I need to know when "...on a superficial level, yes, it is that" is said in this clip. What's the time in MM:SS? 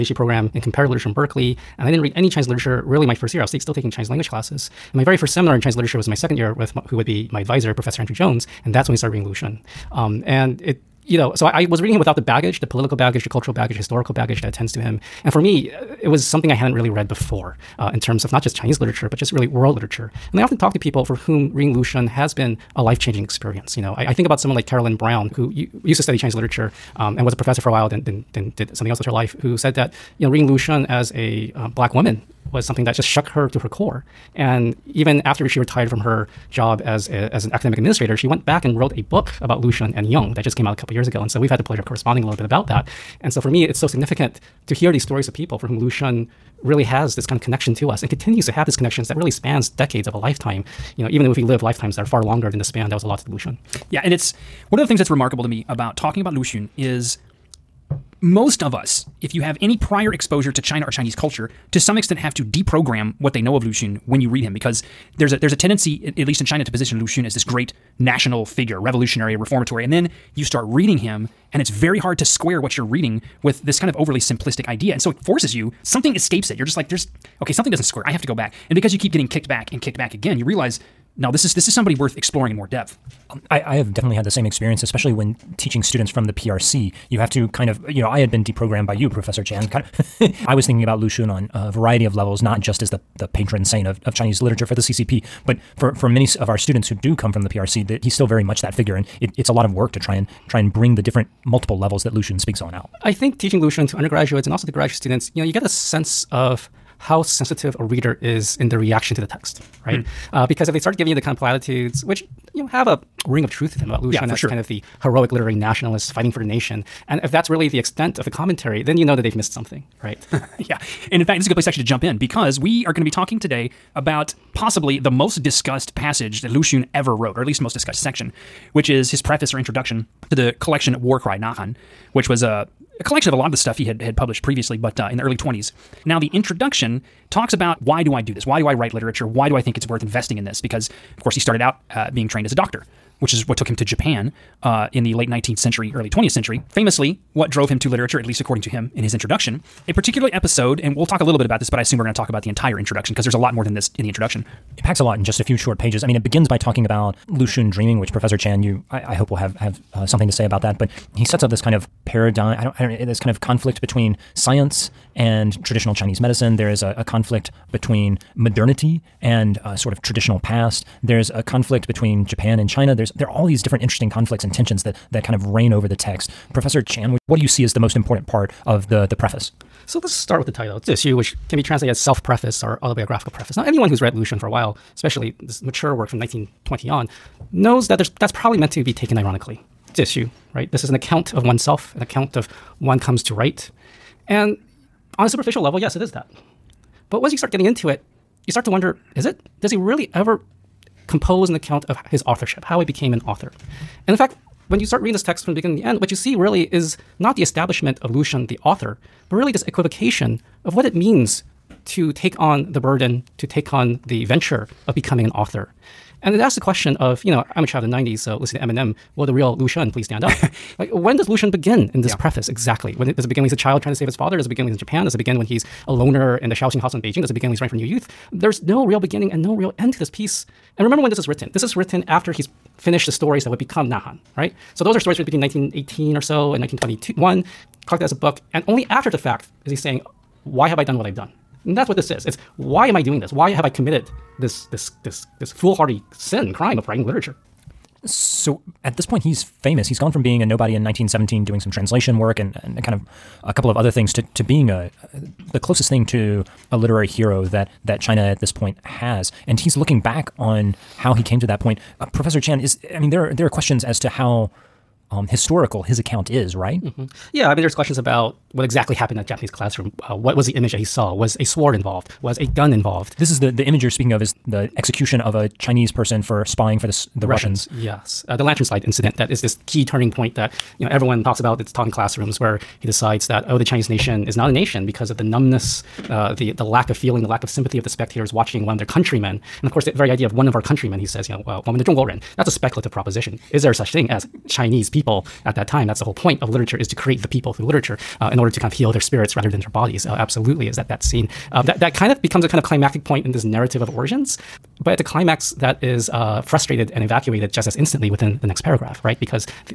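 03:15.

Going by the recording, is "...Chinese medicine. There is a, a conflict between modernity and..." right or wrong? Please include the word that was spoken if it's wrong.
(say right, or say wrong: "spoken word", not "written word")
right.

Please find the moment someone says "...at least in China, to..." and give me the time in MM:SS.
01:06.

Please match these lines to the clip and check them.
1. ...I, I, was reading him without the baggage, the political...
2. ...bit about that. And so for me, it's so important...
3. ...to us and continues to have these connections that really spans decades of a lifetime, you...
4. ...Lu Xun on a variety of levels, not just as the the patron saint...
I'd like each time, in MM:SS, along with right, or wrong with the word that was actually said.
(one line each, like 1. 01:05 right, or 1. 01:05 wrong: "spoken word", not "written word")
1. 00:11 right
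2. 00:42 wrong: "significant", not "important"
3. 00:47 right
4. 01:30 right.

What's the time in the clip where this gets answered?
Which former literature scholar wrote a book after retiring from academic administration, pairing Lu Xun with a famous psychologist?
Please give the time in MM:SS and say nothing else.
00:24.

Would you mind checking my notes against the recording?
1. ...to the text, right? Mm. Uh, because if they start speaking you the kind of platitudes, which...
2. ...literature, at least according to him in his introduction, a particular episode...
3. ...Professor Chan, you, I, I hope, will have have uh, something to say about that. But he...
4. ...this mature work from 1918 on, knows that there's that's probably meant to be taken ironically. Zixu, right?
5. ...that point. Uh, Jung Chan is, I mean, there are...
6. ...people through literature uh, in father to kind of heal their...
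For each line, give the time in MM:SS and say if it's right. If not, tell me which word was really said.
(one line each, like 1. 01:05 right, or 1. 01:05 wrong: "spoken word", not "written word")
1. 01:49 wrong: "giving", not "speaking"
2. 02:27 right
3. 02:38 right
4. 03:05 wrong: "1920", not "1918"
5. 04:21 wrong: "Professor", not "Jung"
6. 04:57 wrong: "order", not "father".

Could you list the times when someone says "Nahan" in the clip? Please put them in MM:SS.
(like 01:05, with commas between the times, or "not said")
02:11, 03:53.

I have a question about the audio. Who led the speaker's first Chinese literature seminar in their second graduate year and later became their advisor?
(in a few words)
Andrew Jones.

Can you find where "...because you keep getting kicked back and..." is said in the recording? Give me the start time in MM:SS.
01:18.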